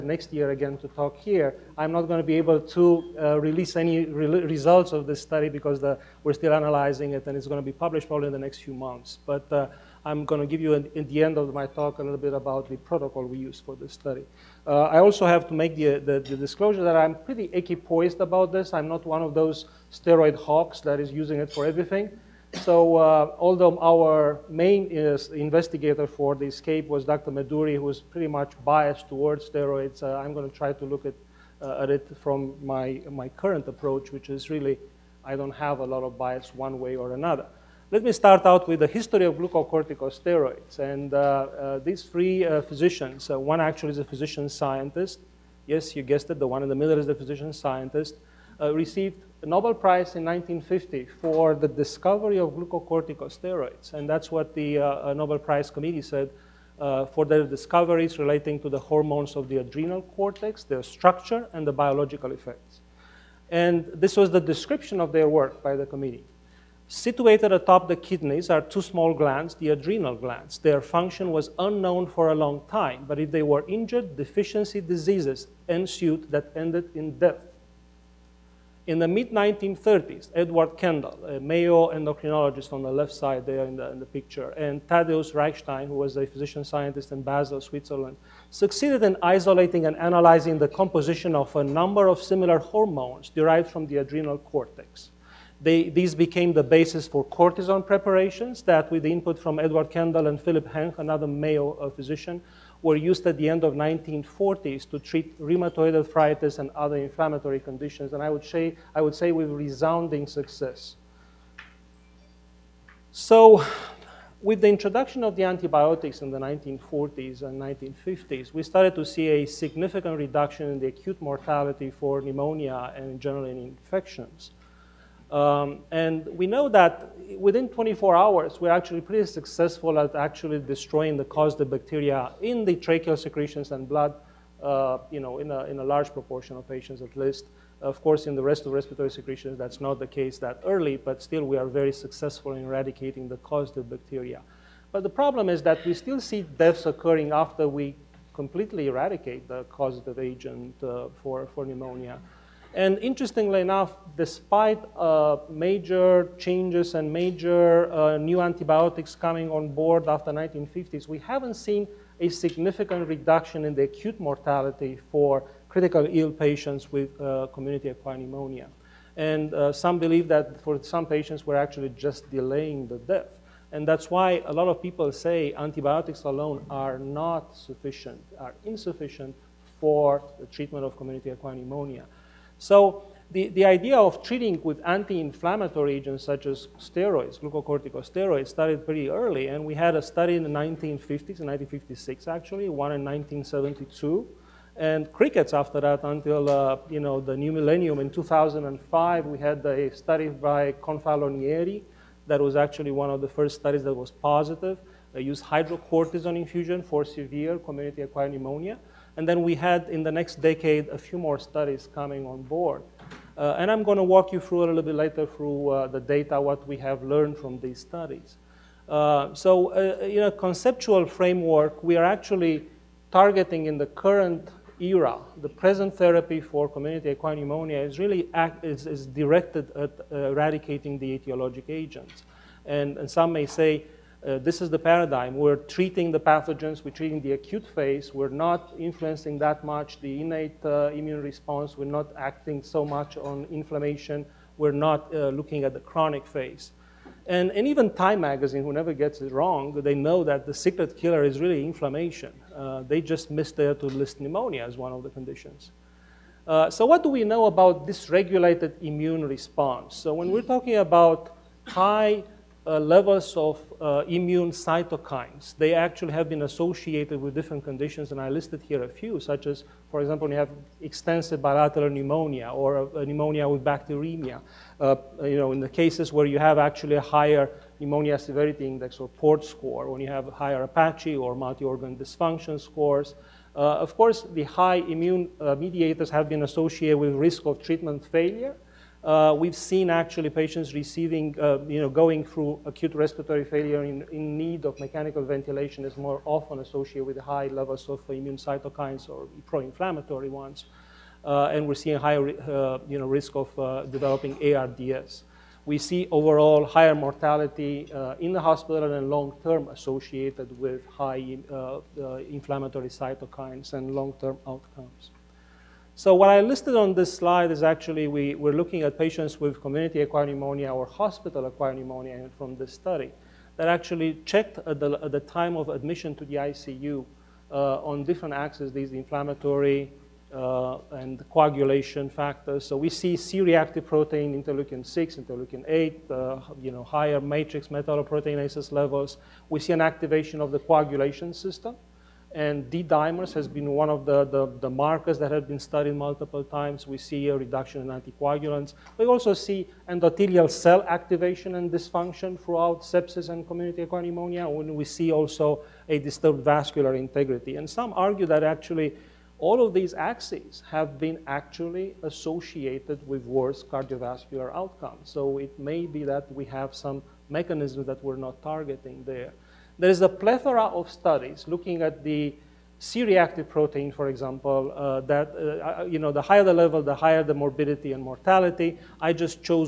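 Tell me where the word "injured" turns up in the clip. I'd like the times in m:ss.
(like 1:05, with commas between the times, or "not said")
1:13.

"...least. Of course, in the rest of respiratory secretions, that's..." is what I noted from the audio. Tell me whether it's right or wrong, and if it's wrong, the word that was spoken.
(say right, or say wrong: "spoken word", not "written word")
right.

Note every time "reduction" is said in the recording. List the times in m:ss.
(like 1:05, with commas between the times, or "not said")
2:00, 2:43, 5:47.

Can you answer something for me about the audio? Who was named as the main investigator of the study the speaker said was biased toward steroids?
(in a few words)
Dr. Meduri.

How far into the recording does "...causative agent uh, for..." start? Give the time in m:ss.
2:29.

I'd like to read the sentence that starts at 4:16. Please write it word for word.
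Uh, so what do we know about dysregulated immune response?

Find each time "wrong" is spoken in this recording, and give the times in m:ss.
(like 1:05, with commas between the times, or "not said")
4:09.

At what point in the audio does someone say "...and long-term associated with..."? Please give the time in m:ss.
5:08.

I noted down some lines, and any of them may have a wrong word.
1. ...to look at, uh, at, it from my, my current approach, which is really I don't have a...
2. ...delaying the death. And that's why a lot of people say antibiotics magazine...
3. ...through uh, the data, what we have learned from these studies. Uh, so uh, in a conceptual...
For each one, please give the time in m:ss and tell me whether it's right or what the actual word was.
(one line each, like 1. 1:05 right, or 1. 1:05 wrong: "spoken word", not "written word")
1. 0:30 right
2. 2:52 wrong: "alone", not "magazine"
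3. 3:35 right.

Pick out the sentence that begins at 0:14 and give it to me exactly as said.
Uh, I also have to make the, the, the, disclosure that I'm pretty equipoised about this.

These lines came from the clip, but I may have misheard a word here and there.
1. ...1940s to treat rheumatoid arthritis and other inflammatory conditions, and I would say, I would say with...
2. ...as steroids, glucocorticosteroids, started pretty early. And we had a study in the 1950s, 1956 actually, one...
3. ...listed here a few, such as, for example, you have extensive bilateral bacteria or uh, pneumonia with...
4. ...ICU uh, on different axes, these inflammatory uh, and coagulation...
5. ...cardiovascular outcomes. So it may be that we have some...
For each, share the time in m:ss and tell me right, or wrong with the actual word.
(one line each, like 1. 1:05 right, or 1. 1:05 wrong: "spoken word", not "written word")
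1. 1:43 right
2. 3:06 right
3. 4:28 wrong: "pneumonia", not "bacteria"
4. 5:26 right
5. 6:03 right.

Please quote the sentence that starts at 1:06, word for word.
Situated atop the kidneys are two small glands, the adrenal glands.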